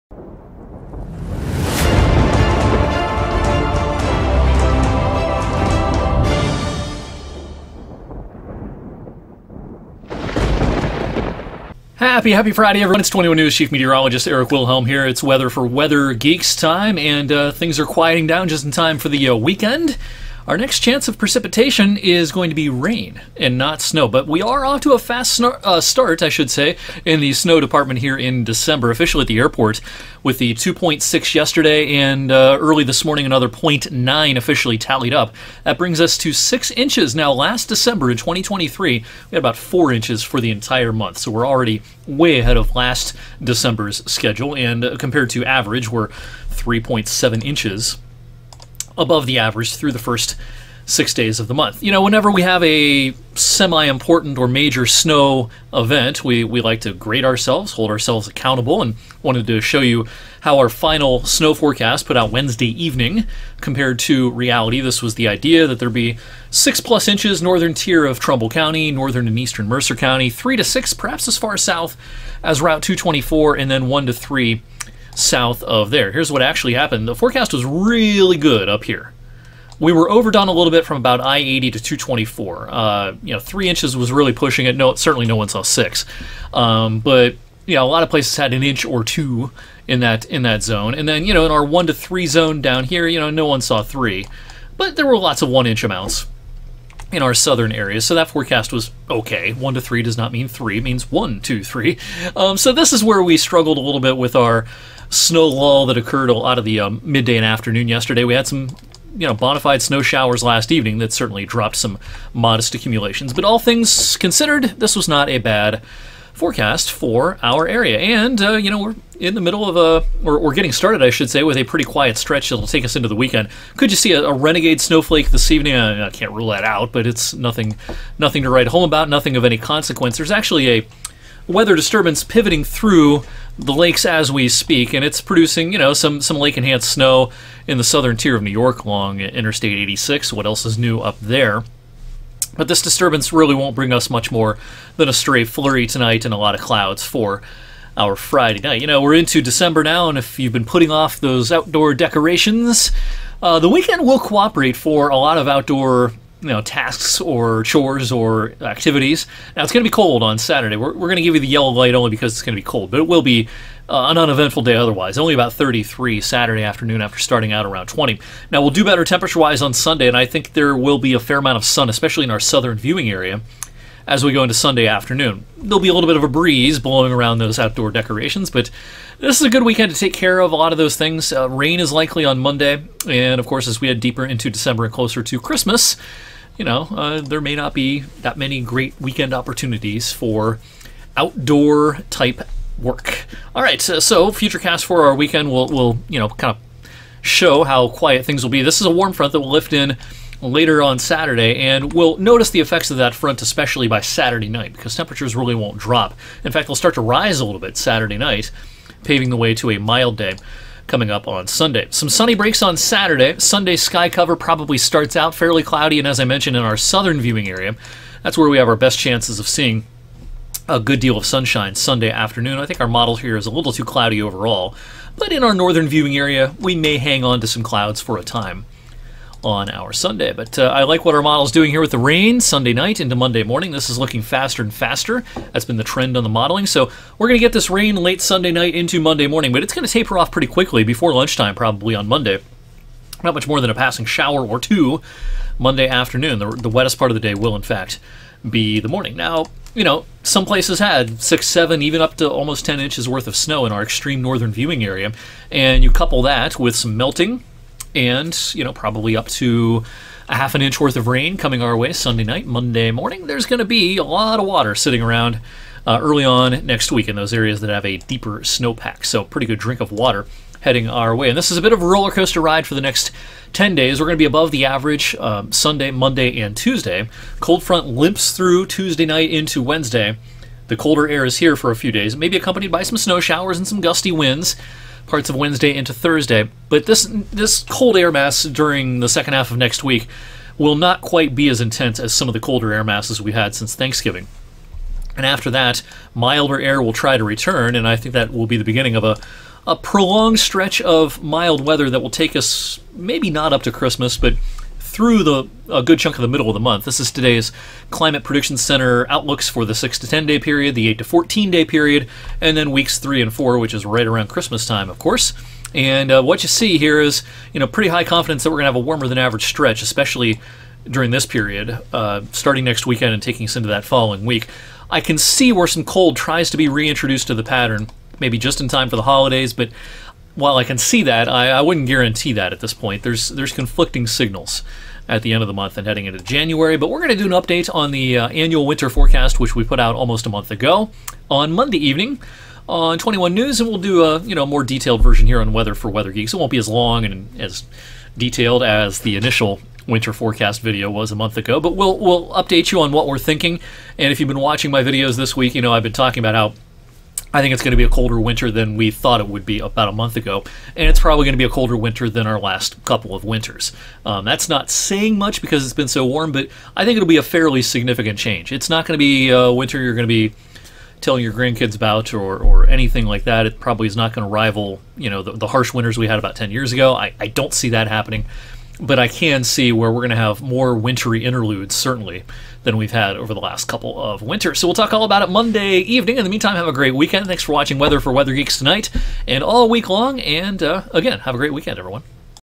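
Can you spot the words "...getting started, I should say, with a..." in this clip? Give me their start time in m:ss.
2:00.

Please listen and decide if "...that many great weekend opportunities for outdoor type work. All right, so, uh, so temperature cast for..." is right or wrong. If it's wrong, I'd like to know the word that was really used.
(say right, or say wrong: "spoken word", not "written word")
wrong: "future", not "temperature".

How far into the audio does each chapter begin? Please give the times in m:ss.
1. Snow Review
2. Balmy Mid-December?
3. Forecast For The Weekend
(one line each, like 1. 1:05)
1. 0:30
2. 4:30
3. 2:00.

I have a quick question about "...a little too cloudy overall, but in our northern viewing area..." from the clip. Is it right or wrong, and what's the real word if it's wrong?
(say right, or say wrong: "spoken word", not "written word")
right.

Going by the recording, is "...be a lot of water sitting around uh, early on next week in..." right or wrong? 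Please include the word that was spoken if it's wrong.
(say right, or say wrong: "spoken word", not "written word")
right.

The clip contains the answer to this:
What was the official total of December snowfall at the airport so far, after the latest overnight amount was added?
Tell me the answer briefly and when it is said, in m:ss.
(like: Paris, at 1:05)
6 inches, at 0:36.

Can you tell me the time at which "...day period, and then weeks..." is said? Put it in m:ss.
5:11.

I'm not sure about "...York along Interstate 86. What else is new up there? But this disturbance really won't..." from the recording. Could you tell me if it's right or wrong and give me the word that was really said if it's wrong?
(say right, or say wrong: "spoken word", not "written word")
right.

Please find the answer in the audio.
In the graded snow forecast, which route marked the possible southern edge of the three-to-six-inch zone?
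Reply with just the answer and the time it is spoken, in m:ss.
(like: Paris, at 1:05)
Route 224, at 1:12.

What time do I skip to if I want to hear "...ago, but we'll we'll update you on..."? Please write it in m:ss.
5:51.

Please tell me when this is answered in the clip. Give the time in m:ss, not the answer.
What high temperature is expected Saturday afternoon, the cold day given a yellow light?
2:45.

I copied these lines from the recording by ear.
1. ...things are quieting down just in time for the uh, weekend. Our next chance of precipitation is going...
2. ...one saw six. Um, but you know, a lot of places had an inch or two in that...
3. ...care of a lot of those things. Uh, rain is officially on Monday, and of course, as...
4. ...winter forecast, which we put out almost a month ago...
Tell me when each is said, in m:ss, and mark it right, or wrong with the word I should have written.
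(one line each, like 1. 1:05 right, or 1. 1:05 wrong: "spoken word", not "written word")
1. 0:17 right
2. 1:25 right
3. 3:00 wrong: "likely", not "officially"
4. 5:38 right.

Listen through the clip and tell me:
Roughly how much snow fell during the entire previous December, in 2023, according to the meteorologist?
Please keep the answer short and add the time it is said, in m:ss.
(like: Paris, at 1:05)
4 inches, at 0:39.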